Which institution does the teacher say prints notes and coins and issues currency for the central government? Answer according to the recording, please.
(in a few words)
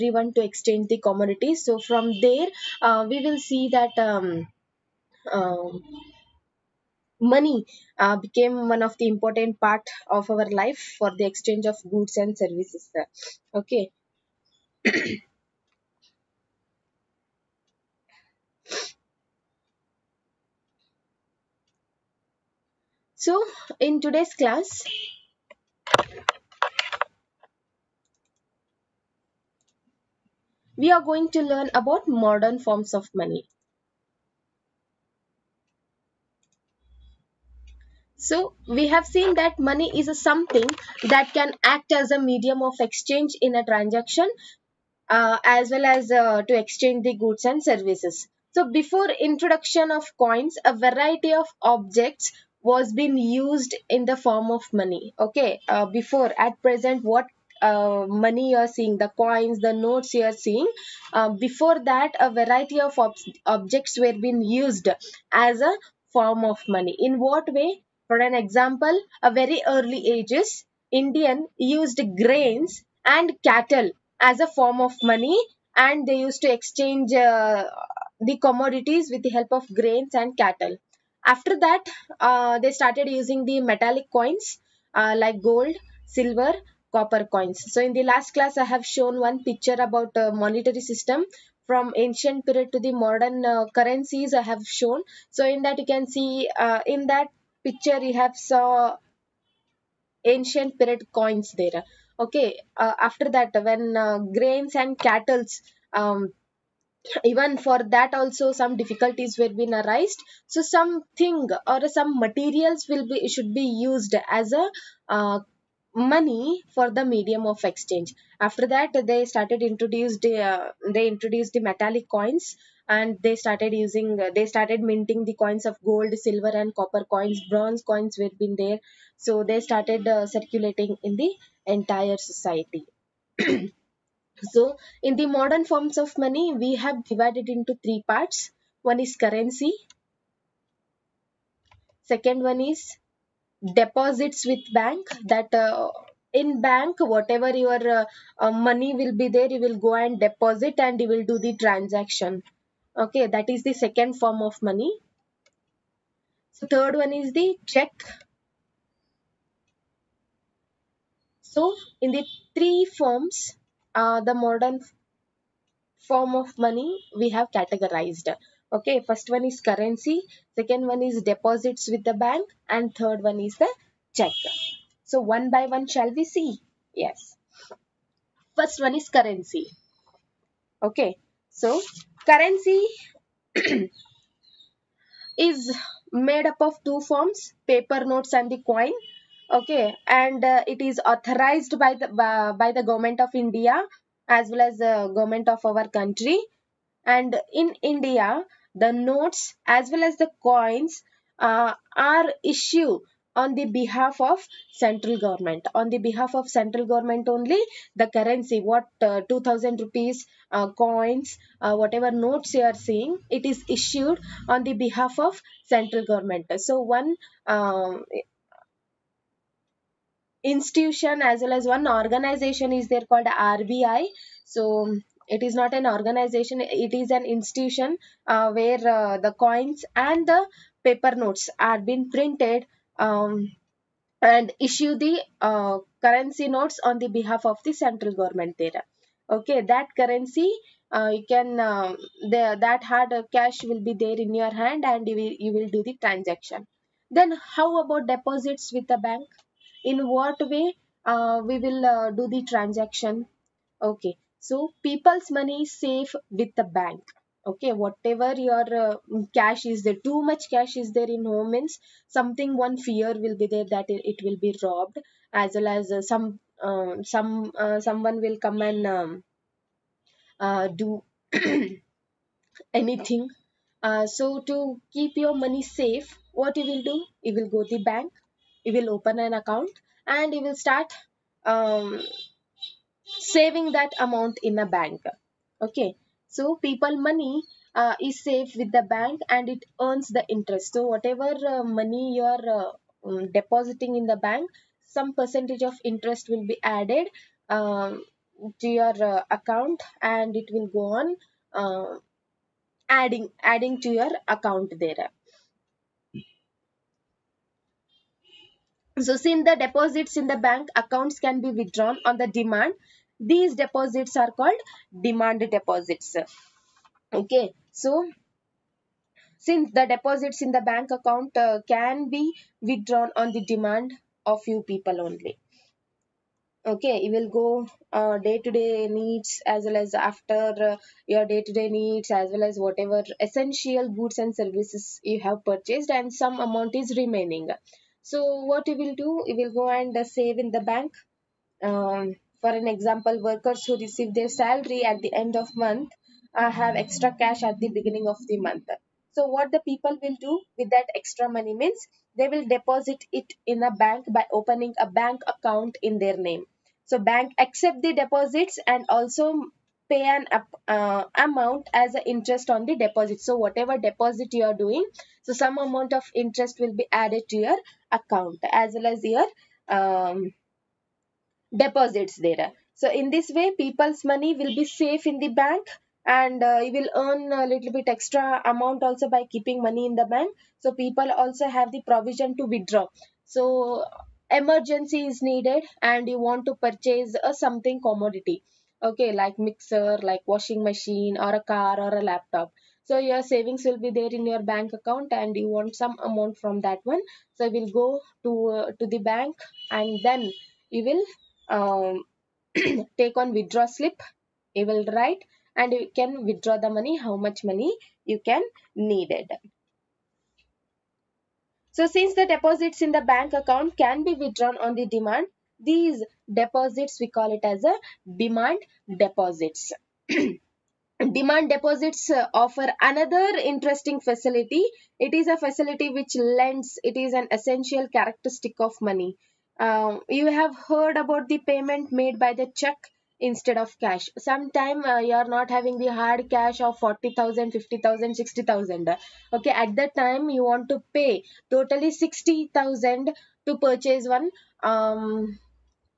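RBI.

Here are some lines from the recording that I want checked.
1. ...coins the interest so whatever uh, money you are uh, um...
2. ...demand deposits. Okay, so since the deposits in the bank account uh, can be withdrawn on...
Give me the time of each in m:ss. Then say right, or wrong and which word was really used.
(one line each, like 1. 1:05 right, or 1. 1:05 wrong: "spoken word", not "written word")
1. 4:49 wrong: "earns", not "coins"
2. 5:15 right.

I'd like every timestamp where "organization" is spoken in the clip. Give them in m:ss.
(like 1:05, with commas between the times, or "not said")
3:41, 3:45.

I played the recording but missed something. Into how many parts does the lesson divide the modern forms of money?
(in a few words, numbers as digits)
3.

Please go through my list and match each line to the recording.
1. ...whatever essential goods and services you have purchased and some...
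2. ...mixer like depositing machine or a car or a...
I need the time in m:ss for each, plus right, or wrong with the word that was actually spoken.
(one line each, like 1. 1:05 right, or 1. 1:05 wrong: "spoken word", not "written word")
1. 5:32 right
2. 6:29 wrong: "washing", not "depositing".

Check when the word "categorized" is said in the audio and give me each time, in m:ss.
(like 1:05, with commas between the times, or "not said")
2:47.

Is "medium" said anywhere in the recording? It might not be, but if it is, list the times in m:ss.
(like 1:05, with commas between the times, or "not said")
0:42, 1:57.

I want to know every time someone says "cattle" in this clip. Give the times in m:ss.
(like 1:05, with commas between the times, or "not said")
1:13, 1:20, 1:44.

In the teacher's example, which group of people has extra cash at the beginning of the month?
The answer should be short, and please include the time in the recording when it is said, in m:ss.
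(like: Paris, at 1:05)
Workers, at 5:43.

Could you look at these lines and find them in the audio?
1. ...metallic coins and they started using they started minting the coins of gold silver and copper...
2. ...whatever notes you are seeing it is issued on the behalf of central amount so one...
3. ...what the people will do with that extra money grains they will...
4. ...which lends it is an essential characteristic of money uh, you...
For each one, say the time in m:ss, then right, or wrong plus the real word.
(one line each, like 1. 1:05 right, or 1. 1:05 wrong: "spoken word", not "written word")
1. 2:01 right
2. 3:31 wrong: "government", not "amount"
3. 5:49 wrong: "means", not "grains"
4. 7:05 right.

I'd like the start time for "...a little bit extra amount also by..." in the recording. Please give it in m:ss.
6:17.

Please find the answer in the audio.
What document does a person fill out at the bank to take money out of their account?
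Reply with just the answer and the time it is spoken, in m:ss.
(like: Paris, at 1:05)
Withdraw slip, at 6:43.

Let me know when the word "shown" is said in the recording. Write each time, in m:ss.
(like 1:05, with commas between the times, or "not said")
1:28, 1:34.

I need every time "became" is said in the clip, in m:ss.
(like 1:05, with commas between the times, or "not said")
0:08.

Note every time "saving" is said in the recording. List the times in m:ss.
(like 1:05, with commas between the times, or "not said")
4:43, 6:33.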